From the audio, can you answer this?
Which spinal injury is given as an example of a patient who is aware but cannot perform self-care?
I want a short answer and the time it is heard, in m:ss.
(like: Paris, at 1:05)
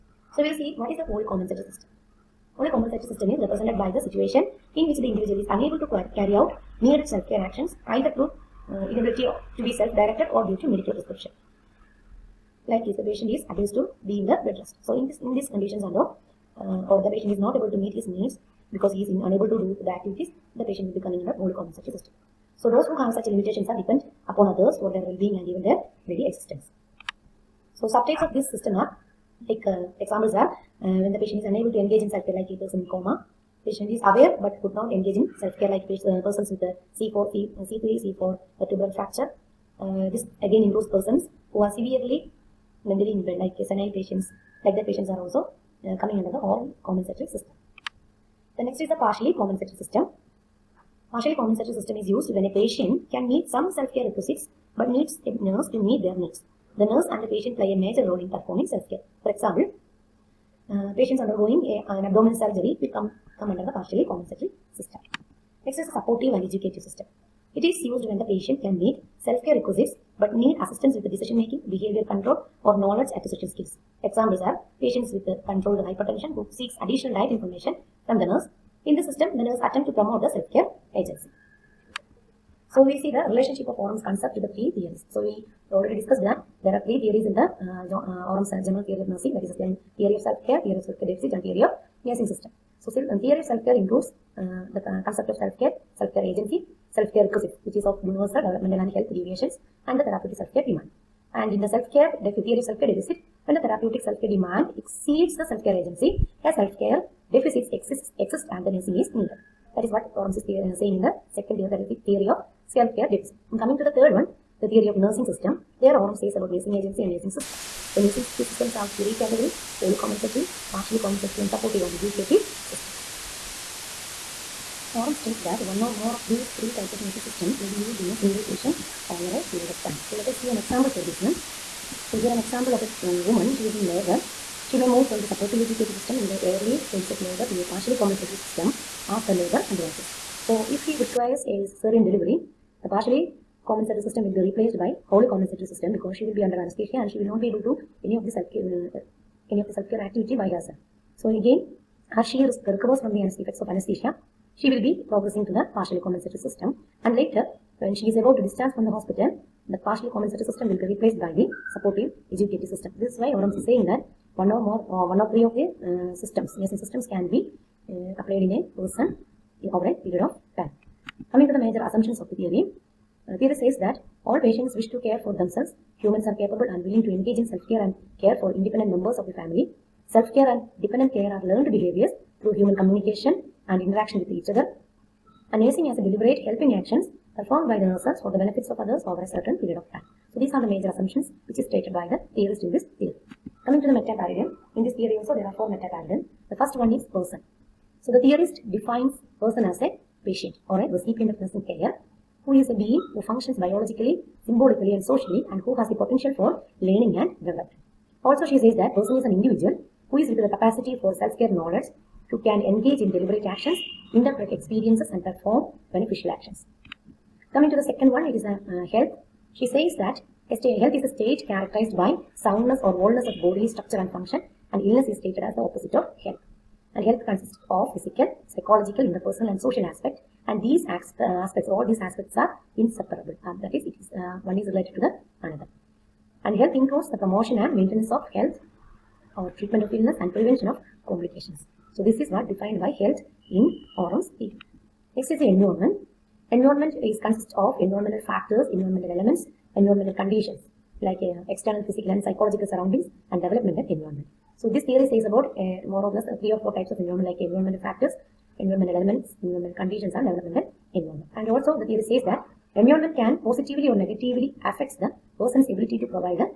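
C3, C4 vertebral fracture, at 0:36.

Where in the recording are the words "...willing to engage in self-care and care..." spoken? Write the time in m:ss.
2:56.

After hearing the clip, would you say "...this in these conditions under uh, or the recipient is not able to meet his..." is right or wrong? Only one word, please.
wrong.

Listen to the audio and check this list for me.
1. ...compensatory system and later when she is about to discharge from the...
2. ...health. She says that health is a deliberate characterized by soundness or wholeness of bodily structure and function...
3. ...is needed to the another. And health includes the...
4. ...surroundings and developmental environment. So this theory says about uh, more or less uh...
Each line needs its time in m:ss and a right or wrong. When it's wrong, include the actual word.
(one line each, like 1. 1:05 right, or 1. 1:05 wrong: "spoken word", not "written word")
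1. 2:36 right
2. 3:38 wrong: "state", not "deliberate"
3. 3:54 wrong: "related", not "needed"
4. 4:12 right.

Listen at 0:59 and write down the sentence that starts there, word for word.
For example, uh, patients undergoing a, an abdominal surgery will come, come under the partially compensatory system.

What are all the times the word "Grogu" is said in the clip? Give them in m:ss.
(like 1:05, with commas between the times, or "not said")
not said.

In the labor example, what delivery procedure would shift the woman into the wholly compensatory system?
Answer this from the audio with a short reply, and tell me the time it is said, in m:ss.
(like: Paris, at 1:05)
Cesarean delivery, at 2:21.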